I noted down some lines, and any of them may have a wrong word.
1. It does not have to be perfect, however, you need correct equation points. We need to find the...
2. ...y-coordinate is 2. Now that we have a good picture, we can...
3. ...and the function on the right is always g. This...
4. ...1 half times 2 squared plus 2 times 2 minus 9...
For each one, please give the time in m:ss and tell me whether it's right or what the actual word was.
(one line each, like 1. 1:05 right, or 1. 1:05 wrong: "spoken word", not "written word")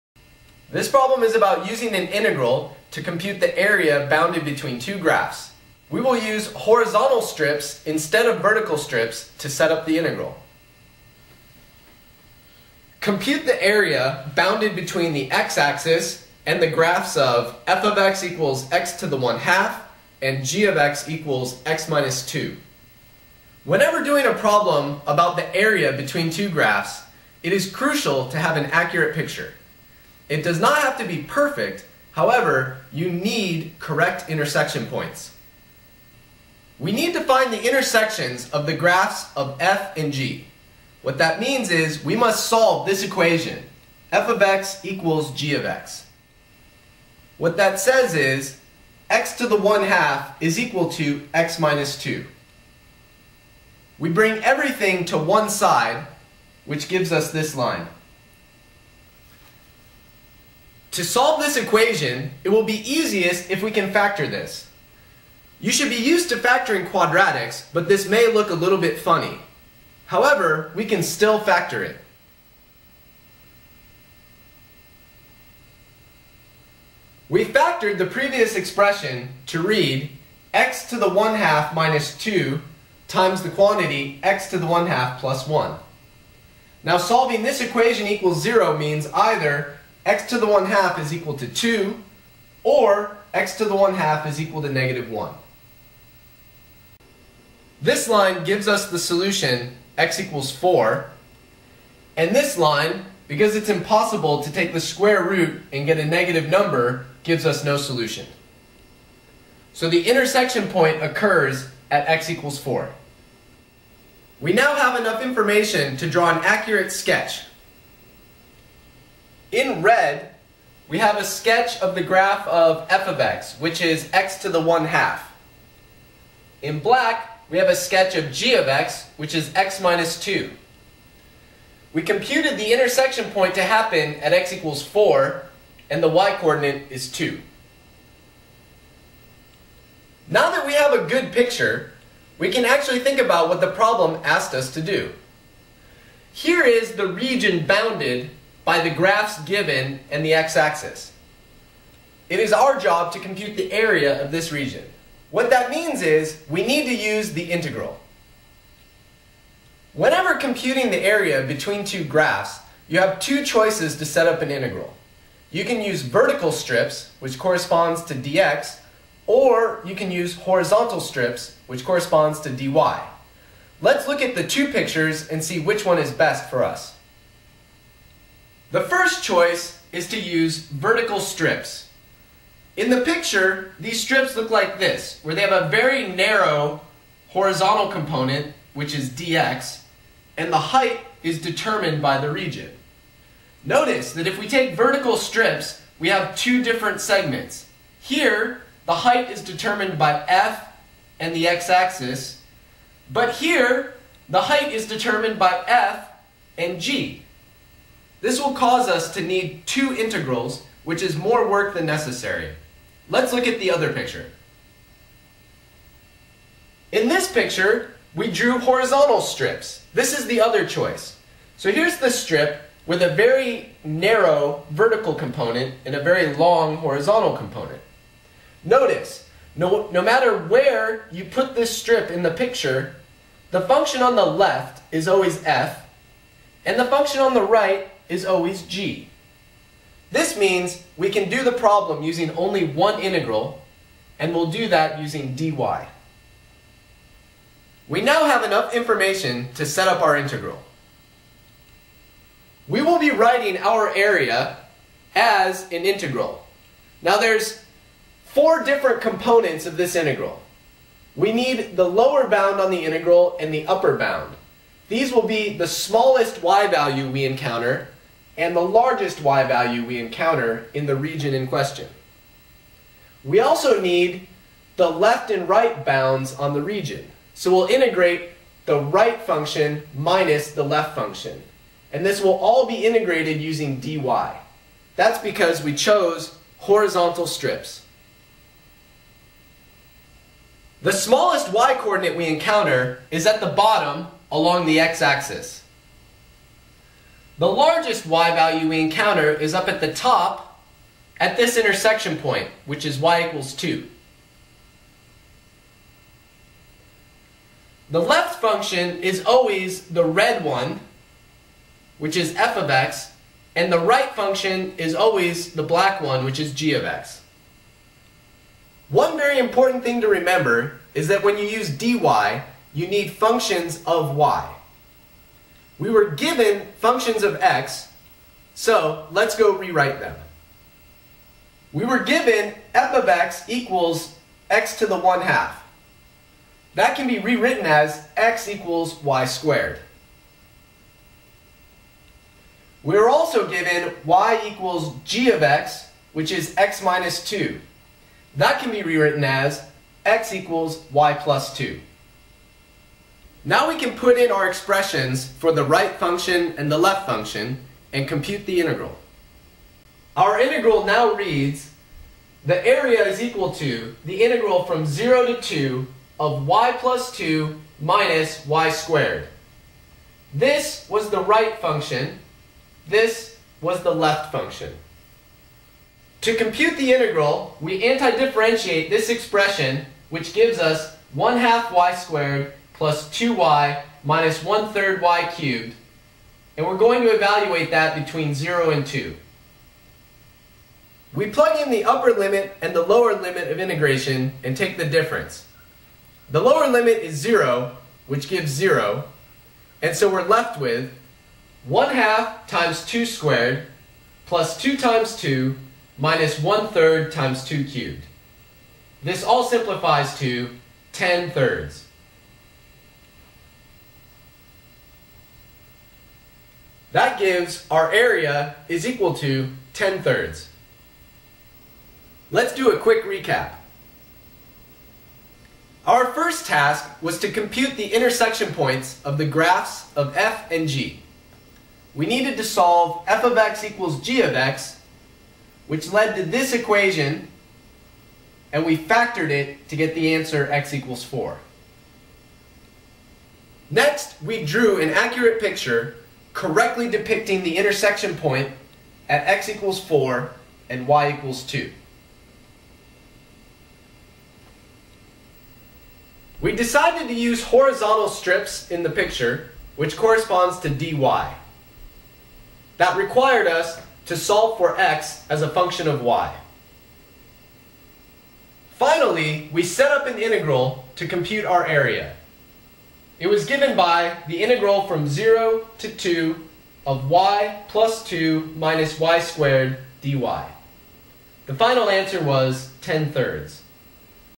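1. 0:30 wrong: "intersection", not "equation"
2. 2:16 right
3. 3:56 right
4. 6:41 wrong: "1", not "9".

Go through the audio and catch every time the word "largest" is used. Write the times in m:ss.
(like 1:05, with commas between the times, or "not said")
4:28, 4:57.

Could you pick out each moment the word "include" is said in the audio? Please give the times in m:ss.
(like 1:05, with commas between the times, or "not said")
not said.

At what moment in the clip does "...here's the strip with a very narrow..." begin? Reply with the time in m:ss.
3:41.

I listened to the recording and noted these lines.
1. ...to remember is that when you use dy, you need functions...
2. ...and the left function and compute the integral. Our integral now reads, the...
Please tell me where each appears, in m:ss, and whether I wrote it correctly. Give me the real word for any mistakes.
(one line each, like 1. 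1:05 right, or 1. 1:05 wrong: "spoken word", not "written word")
1. 5:20 right
2. 5:56 right.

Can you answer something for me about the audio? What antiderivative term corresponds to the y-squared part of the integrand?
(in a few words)
1/3 y^3.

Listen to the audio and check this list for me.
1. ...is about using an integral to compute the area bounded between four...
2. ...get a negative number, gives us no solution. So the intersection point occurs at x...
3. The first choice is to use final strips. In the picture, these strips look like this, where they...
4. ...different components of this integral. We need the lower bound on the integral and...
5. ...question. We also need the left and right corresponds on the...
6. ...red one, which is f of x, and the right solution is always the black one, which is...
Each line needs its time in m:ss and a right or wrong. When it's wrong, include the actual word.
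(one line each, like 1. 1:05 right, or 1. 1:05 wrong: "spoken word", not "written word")
1. 0:01 wrong: "two", not "four"
2. 1:45 right
3. 2:58 wrong: "vertical", not "final"
4. 4:18 right
5. 4:31 wrong: "bounds", not "corresponds"
6. 5:10 wrong: "function", not "solution".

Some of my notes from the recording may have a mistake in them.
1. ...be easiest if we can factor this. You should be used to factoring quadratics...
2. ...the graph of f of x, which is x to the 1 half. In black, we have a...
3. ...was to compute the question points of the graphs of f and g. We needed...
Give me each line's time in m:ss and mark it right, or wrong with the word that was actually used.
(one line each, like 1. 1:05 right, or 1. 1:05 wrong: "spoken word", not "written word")
1. 1:02 right
2. 2:01 right
3. 7:07 wrong: "intersection", not "question".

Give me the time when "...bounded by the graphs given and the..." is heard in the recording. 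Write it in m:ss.
2:27.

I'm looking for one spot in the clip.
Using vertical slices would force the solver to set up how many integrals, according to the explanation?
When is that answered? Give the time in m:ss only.
3:29.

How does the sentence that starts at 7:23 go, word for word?
Next, we drew an accurate picture correctly depicting the intersection point at x equals 4 and y equals 2.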